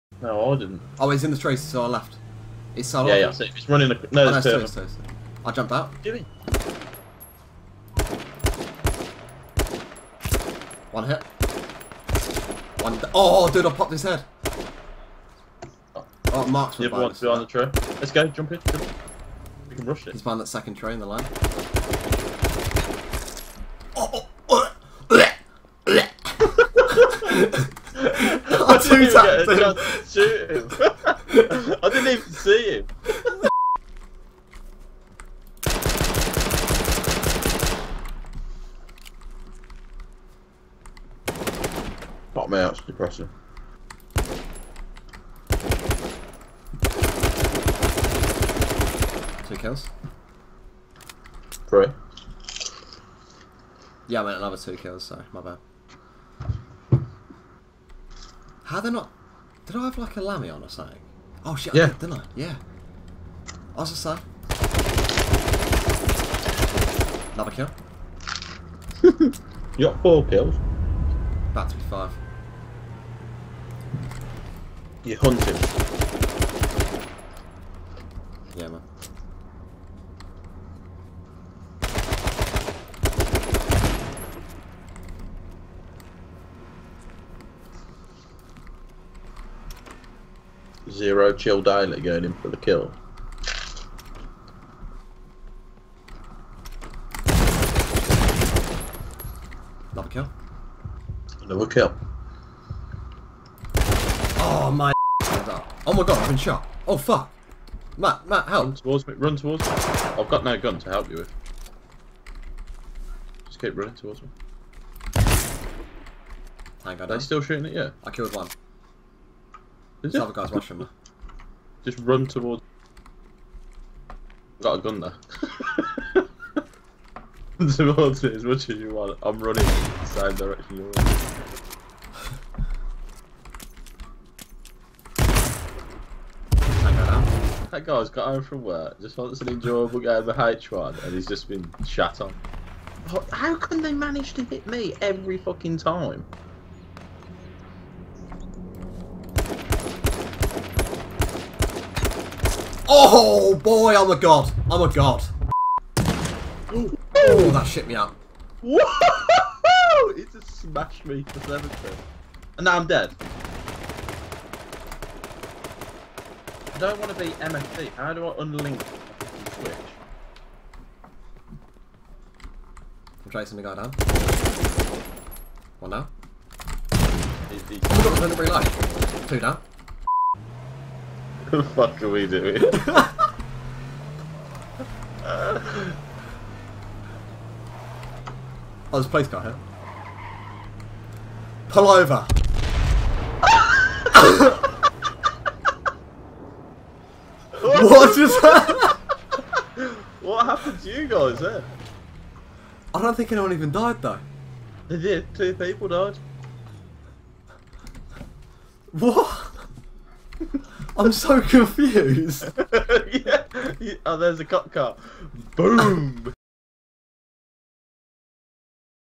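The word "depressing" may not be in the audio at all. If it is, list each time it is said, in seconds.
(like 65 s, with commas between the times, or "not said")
42 s.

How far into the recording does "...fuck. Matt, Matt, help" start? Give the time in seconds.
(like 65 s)
106 s.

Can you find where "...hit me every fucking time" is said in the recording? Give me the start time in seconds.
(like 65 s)
144 s.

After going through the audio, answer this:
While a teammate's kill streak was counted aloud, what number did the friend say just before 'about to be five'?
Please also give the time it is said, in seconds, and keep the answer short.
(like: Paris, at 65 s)
4, at 70 s.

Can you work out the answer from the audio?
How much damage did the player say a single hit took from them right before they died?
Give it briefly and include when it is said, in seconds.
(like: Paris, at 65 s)
70, at 161 s.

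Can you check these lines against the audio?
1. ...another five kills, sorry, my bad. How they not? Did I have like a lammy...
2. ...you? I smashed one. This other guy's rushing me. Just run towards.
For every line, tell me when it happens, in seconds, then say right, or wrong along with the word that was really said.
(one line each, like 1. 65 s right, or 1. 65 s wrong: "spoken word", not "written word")
1. 54 s wrong: "two", not "five"
2. 117 s wrong: "killed", not "smashed".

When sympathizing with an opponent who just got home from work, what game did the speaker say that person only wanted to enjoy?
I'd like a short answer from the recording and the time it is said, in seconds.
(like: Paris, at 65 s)
H1, at 140 s.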